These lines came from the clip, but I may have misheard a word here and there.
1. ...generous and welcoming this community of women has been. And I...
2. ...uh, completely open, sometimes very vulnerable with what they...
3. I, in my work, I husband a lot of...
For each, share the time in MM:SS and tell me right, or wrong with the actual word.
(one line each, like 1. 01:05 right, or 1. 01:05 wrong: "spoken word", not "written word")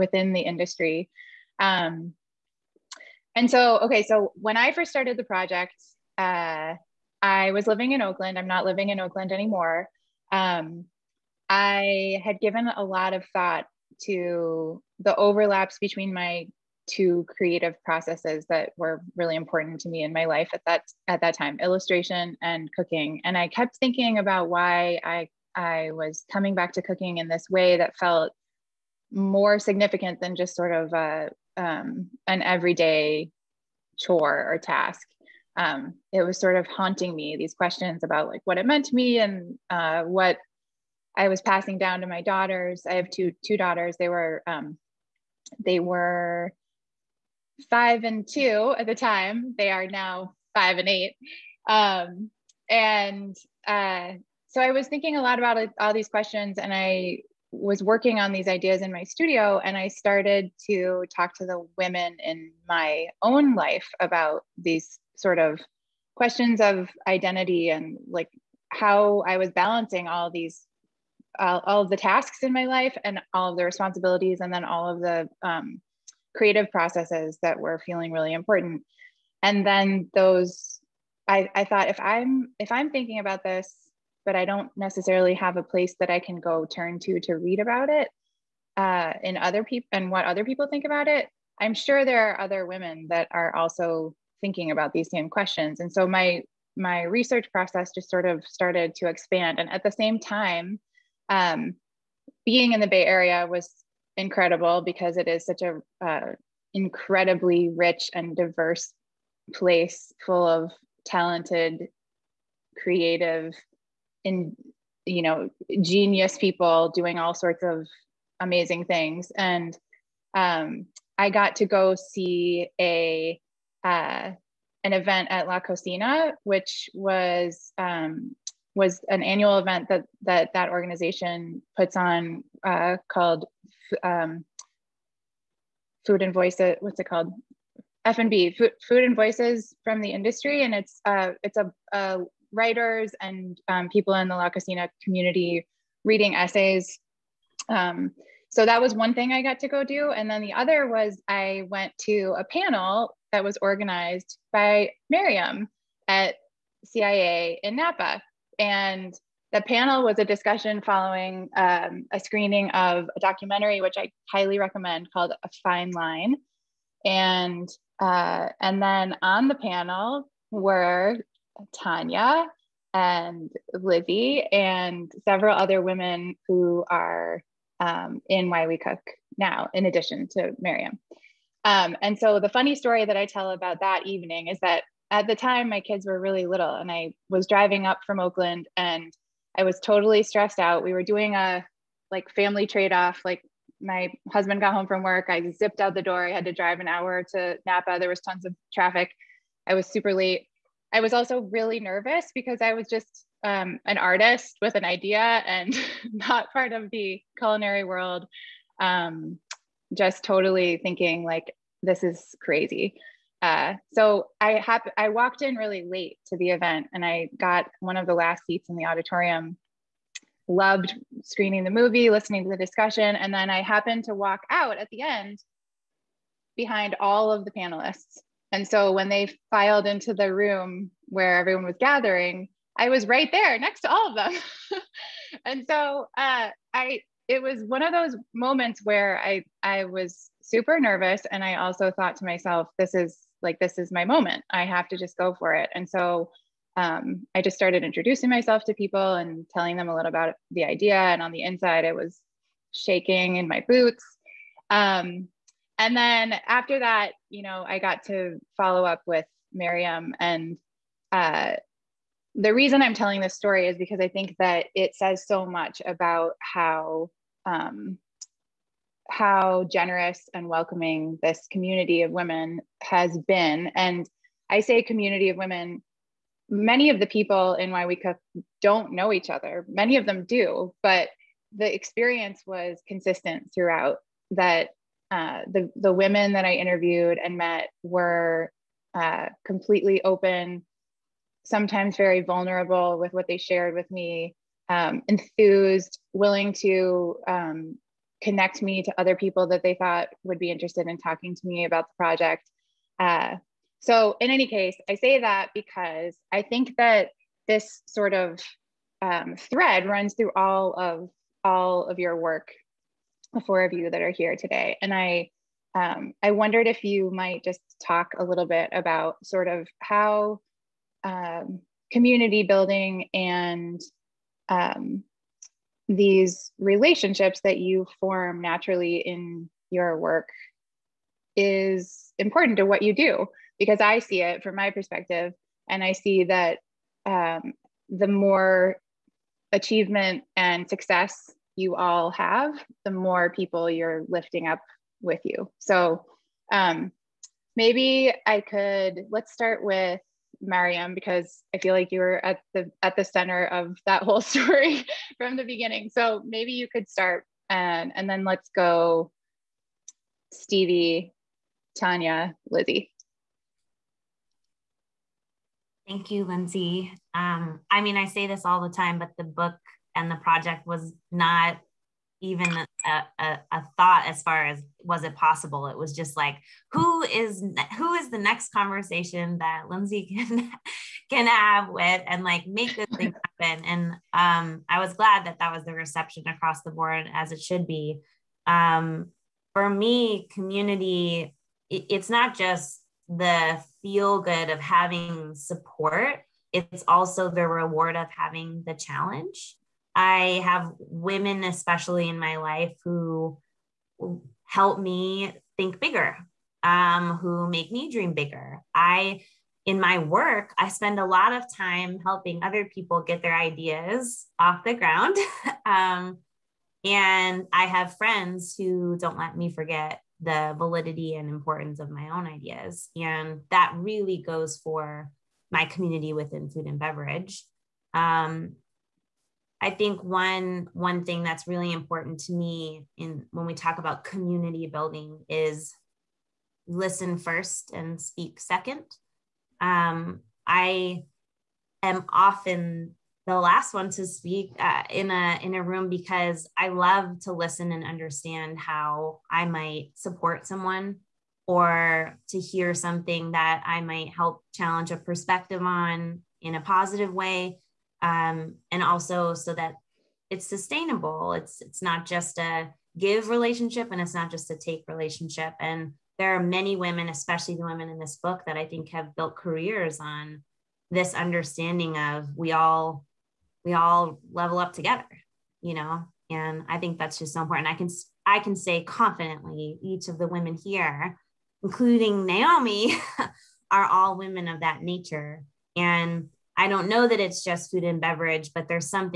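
1. 04:29 right
2. 04:48 right
3. 06:48 wrong: "spend", not "husband".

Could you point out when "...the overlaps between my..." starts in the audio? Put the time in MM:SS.
00:14.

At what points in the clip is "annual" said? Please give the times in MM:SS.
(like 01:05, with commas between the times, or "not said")
02:09.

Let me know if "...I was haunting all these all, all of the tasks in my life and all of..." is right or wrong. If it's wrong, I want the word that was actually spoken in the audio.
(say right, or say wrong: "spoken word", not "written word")
wrong: "balancing", not "haunting".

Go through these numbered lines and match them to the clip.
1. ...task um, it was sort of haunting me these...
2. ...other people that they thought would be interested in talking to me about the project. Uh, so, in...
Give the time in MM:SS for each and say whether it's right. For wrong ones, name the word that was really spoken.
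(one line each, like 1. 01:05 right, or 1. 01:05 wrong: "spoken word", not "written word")
1. 00:34 right
2. 04:58 right.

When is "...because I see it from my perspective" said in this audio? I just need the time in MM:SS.
05:33.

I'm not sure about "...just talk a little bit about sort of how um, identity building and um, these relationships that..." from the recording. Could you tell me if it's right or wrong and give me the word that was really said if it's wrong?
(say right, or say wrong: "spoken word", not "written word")
wrong: "community", not "identity".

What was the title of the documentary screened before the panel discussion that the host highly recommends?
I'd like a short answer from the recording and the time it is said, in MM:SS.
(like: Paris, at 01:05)
A Fine Line, at 02:45.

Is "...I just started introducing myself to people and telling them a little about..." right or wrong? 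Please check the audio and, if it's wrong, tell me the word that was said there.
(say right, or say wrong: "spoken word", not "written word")
right.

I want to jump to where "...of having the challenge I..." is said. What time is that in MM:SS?
06:37.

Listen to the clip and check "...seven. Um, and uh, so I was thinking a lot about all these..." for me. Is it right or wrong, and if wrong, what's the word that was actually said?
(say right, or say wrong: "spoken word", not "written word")
wrong: "eight", not "seven".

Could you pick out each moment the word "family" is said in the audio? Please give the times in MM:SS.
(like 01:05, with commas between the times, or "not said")
03:12.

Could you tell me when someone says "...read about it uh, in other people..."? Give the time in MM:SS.
01:27.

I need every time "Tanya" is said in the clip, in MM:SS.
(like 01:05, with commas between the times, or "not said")
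02:51, 06:01.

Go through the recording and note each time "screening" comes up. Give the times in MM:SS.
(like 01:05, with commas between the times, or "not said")
02:42, 03:41.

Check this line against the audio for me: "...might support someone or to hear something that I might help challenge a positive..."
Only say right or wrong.
wrong.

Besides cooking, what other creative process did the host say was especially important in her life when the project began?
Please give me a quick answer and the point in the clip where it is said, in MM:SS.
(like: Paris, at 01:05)
Illustration, at 00:21.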